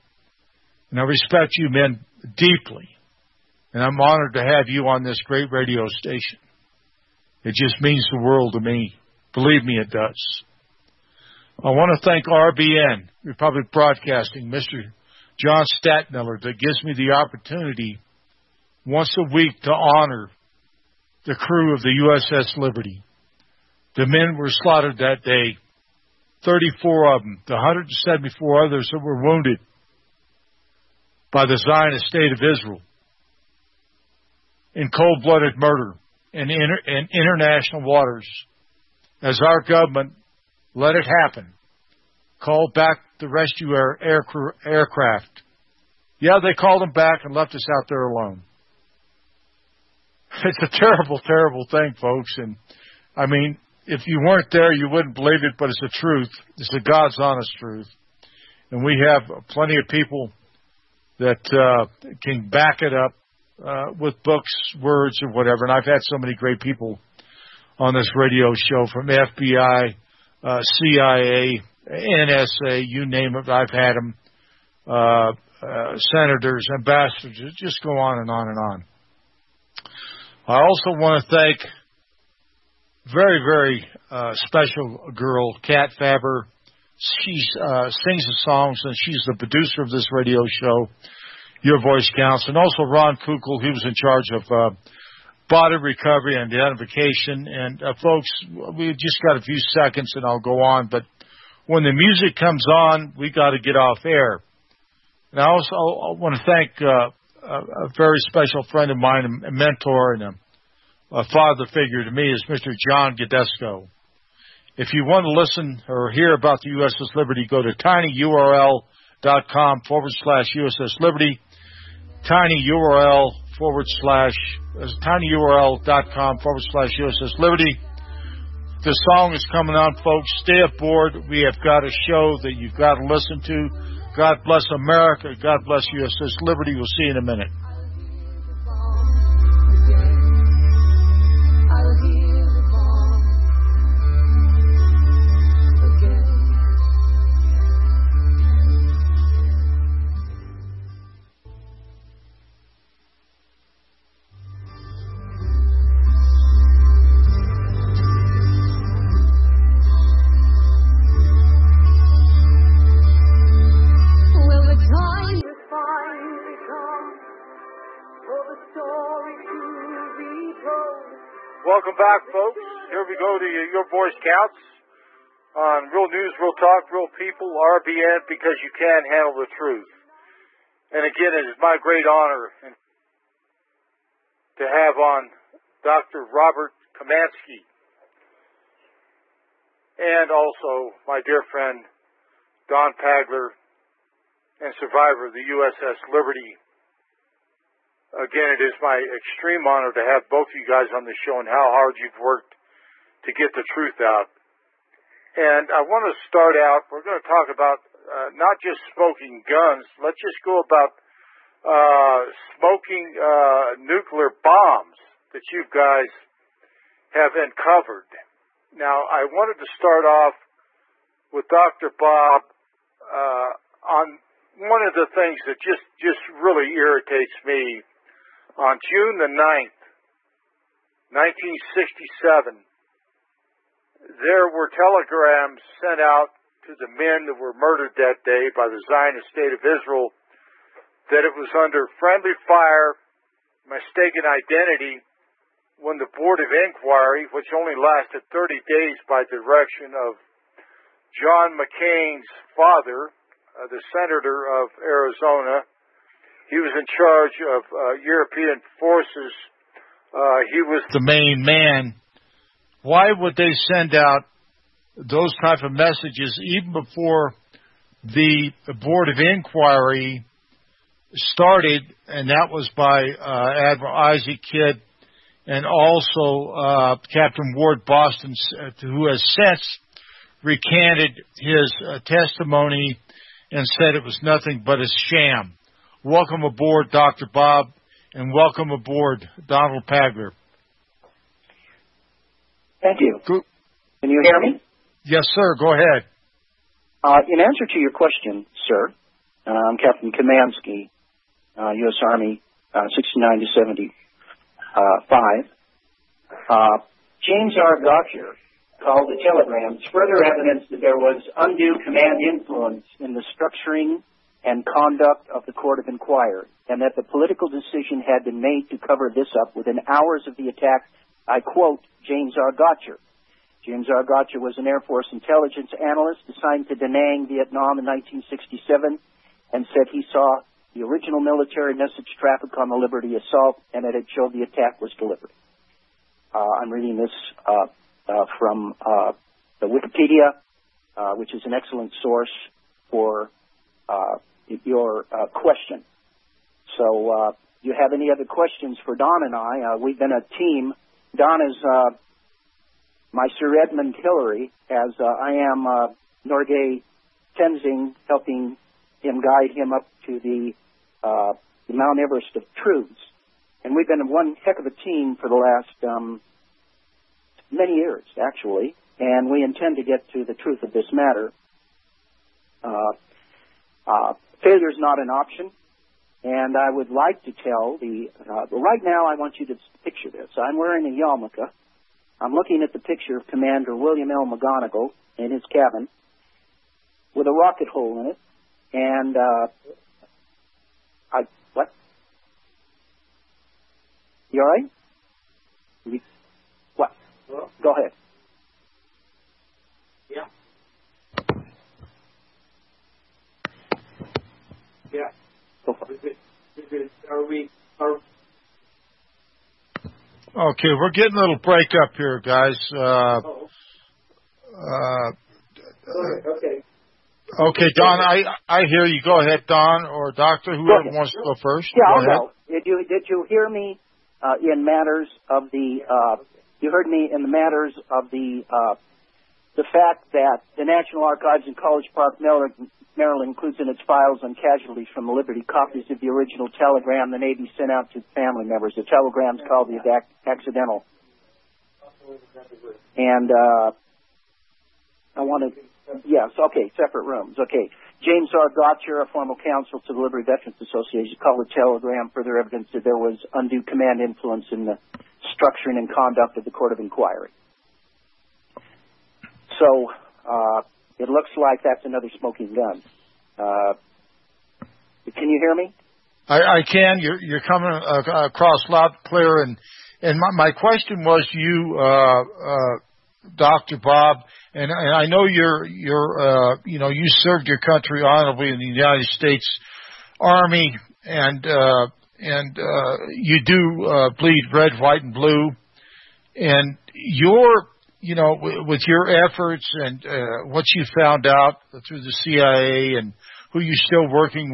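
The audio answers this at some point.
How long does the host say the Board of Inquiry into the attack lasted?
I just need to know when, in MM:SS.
04:08.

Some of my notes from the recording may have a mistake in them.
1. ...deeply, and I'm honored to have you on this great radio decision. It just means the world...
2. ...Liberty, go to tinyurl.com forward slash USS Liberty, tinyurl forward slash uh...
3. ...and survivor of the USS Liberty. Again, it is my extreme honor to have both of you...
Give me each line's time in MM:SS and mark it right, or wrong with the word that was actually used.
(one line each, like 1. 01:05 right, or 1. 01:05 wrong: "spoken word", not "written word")
1. 00:02 wrong: "station", not "decision"
2. 01:57 right
3. 03:14 right.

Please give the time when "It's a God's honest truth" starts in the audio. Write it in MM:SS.
00:56.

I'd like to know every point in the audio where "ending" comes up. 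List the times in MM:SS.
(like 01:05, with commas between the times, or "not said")
not said.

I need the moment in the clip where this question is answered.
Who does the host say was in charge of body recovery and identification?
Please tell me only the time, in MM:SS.
01:32.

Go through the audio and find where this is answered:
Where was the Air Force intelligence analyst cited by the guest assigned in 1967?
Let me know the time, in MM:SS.
05:26.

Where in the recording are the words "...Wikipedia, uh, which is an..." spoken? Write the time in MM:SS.
05:39.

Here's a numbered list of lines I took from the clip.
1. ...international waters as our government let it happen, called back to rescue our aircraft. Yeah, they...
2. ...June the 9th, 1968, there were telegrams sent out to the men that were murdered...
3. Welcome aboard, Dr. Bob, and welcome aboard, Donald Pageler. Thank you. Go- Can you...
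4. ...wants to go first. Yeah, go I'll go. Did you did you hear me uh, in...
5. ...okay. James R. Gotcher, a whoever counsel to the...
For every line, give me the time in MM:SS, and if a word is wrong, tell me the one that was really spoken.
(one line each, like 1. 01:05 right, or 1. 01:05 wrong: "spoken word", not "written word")
1. 00:37 right
2. 03:48 wrong: "1967", not "1968"
3. 04:46 right
4. 07:00 right
5. 07:27 wrong: "former", not "whoever".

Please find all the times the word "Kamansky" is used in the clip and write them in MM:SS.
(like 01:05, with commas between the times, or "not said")
03:06, 05:00.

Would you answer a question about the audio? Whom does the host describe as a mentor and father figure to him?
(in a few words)
John Gidusko.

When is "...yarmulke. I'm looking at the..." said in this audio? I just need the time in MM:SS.
06:20.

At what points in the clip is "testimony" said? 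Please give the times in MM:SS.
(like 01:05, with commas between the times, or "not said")
04:42.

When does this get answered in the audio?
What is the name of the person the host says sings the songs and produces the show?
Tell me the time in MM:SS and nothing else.
01:25.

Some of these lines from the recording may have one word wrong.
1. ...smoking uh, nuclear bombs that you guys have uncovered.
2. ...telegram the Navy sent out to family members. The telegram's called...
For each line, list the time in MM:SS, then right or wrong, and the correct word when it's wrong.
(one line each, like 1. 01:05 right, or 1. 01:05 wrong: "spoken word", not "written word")
1. 03:32 right
2. 07:16 right.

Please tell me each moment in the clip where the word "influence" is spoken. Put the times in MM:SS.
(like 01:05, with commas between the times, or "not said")
05:12, 07:34.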